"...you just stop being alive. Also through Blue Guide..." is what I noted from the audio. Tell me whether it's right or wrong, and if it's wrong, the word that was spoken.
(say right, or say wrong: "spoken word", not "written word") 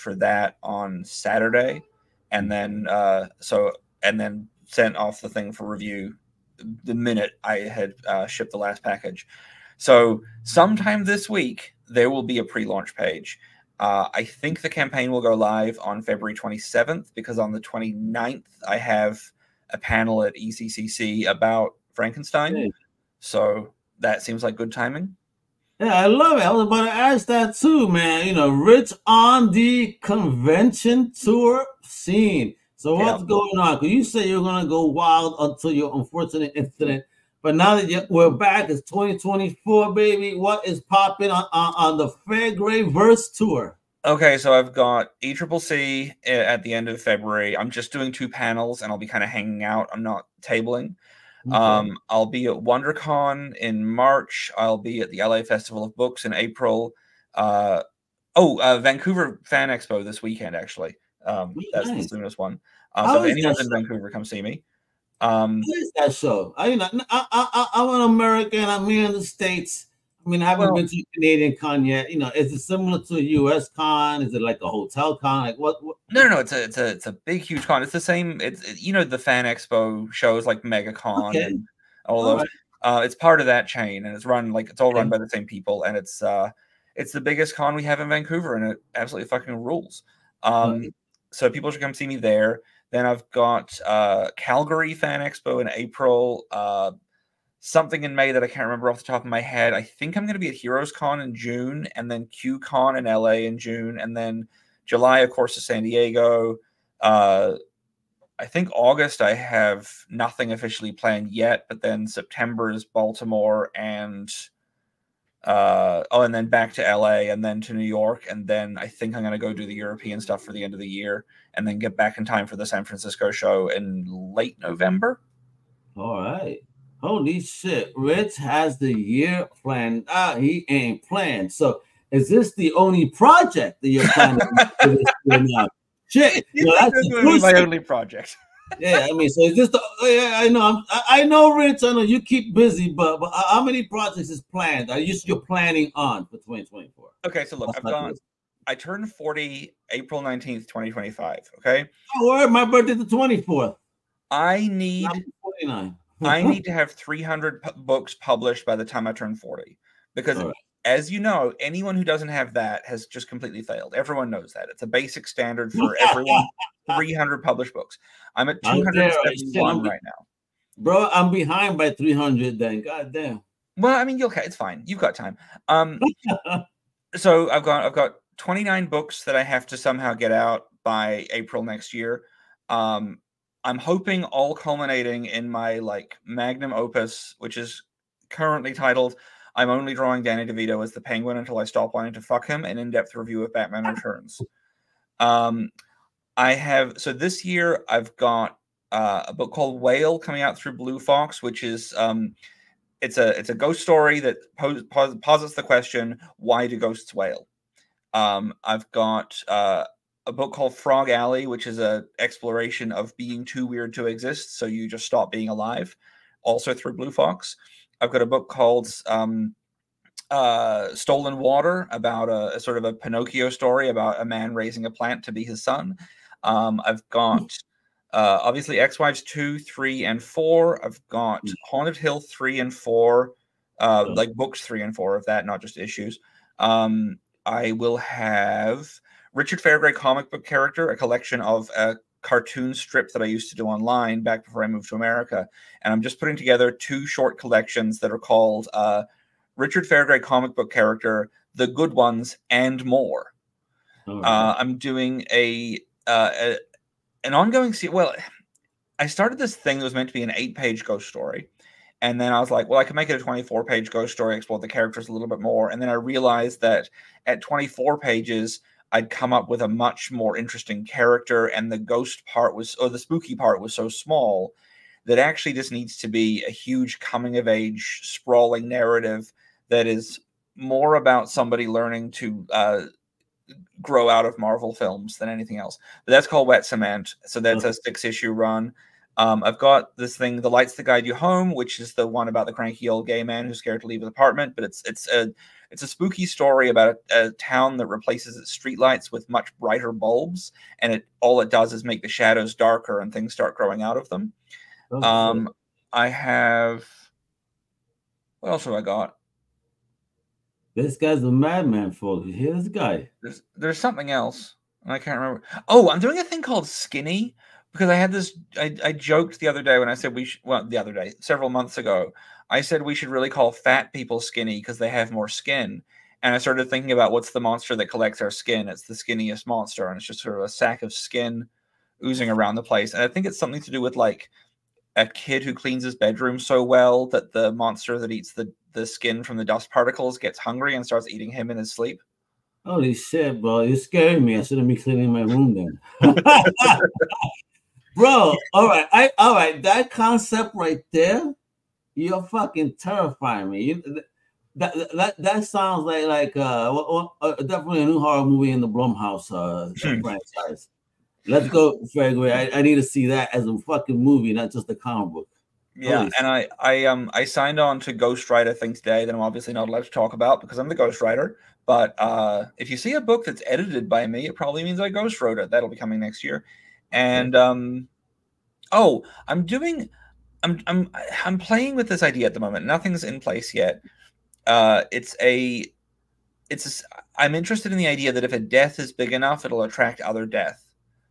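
wrong: "Fox", not "Guide".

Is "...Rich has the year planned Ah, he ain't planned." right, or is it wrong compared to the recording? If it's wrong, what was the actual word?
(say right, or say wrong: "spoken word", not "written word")
right.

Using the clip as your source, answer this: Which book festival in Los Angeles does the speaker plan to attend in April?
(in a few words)
LA Festival of Books.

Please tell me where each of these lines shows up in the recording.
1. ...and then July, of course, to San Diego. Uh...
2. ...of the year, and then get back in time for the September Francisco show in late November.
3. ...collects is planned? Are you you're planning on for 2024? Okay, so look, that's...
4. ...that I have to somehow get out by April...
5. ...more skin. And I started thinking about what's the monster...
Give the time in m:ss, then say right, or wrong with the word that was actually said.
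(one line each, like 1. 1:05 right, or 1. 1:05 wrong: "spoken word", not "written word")
1. 1:43 right
2. 2:00 wrong: "San", not "September"
3. 2:23 wrong: "projects", not "collects"
4. 2:59 right
5. 5:25 right.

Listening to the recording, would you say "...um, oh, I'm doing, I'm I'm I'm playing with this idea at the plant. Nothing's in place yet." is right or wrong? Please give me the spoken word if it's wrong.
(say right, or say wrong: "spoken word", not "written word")
wrong: "moment", not "plant".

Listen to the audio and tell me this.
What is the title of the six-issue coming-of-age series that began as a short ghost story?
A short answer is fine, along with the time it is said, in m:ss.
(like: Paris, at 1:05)
Wet Cement, at 4:46.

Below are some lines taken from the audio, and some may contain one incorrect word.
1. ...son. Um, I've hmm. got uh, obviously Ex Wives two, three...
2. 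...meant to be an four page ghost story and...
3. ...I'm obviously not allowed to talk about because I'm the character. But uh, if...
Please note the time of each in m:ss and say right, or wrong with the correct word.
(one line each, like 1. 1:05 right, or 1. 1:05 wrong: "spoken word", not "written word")
1. 3:45 right
2. 4:19 wrong: "eight", not "four"
3. 6:09 wrong: "ghostwriter", not "character".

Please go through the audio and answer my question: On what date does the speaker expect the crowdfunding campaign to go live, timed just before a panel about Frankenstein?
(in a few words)
February 27th.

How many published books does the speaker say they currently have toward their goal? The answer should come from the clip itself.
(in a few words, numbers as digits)
271.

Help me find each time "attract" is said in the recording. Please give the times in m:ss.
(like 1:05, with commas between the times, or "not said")
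6:29.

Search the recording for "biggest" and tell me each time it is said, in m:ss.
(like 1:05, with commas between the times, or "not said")
1:27.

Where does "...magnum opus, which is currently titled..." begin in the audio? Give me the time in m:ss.
3:06.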